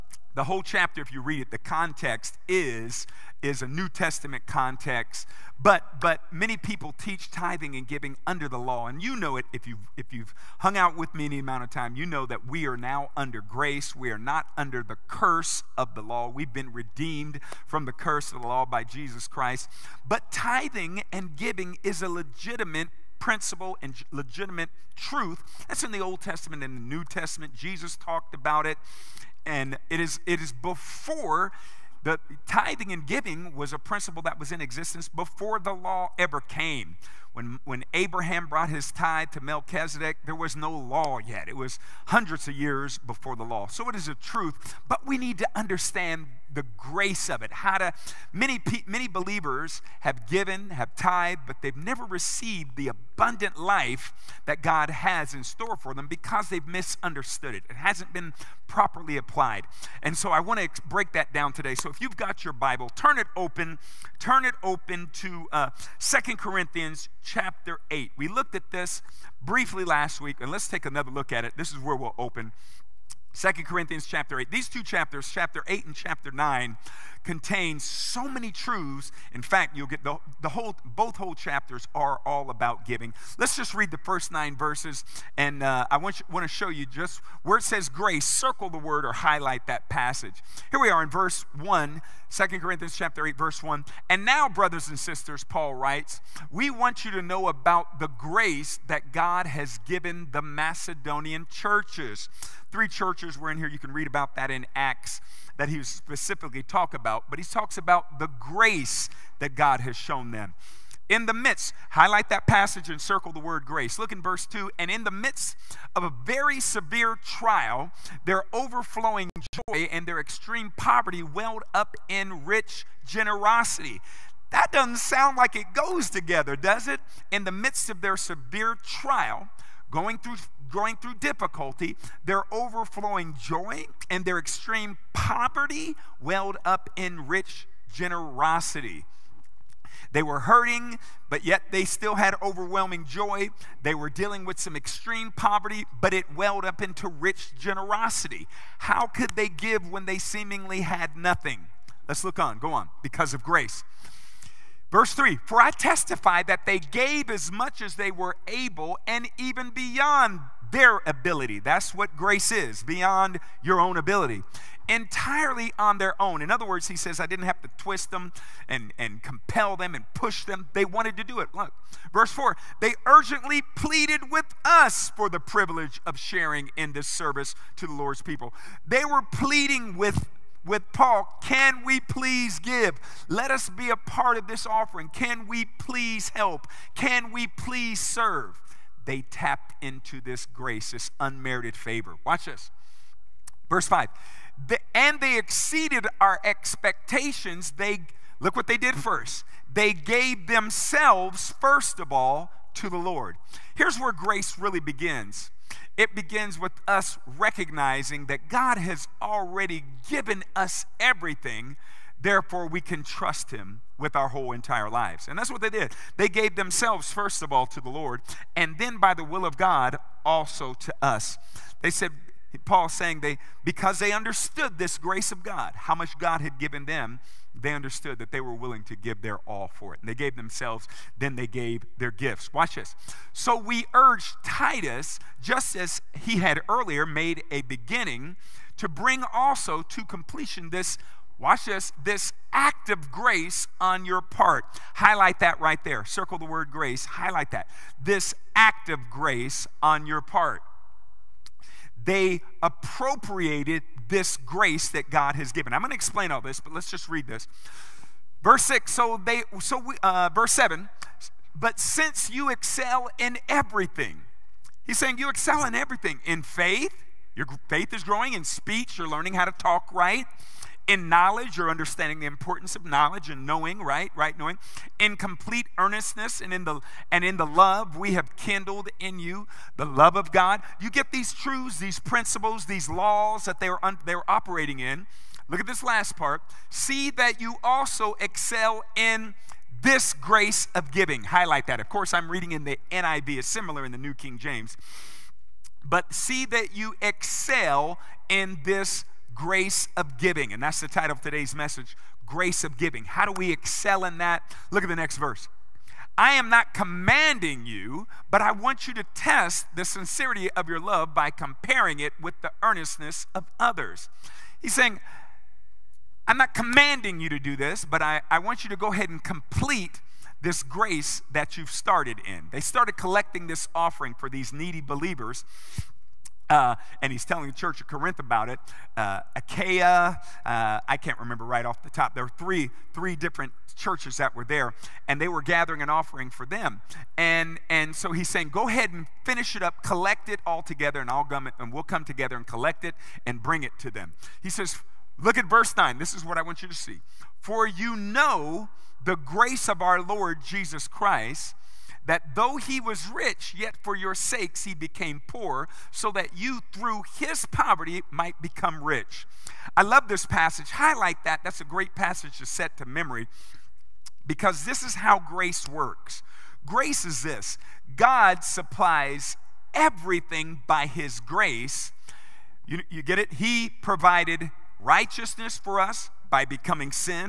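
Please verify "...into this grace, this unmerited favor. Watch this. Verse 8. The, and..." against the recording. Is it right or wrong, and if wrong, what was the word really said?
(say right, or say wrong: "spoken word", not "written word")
wrong: "5", not "8".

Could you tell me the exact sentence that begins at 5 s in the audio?
But, but many people teach tithing and giving under the law.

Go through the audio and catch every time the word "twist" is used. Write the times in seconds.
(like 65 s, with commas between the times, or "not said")
167 s.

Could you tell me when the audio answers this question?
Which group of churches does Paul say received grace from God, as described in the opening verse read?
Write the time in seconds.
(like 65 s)
100 s.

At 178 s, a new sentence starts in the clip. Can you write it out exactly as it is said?
They were pleading with with Paul, Can we please give?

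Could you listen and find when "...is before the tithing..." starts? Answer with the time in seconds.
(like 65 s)
30 s.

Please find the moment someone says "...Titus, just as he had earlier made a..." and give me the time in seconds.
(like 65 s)
234 s.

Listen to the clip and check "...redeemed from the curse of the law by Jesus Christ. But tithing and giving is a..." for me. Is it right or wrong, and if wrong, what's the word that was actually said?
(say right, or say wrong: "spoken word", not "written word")
right.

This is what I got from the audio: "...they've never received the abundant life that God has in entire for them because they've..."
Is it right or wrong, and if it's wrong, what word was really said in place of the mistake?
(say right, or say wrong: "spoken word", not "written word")
wrong: "store", not "entire".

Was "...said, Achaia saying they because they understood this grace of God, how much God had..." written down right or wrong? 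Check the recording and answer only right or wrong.
wrong.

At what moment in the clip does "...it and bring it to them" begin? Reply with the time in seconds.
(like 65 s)
342 s.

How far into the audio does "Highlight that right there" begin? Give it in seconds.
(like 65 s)
244 s.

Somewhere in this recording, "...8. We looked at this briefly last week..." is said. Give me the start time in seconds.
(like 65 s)
67 s.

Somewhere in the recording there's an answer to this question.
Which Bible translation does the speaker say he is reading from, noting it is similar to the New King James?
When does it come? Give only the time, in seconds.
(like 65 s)
292 s.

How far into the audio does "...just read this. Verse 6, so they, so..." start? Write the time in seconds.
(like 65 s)
256 s.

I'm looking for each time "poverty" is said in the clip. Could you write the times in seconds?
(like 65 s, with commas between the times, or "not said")
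120 s, 135 s, 145 s, 357 s.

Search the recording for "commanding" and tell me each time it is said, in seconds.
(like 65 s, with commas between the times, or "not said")
306 s, 316 s.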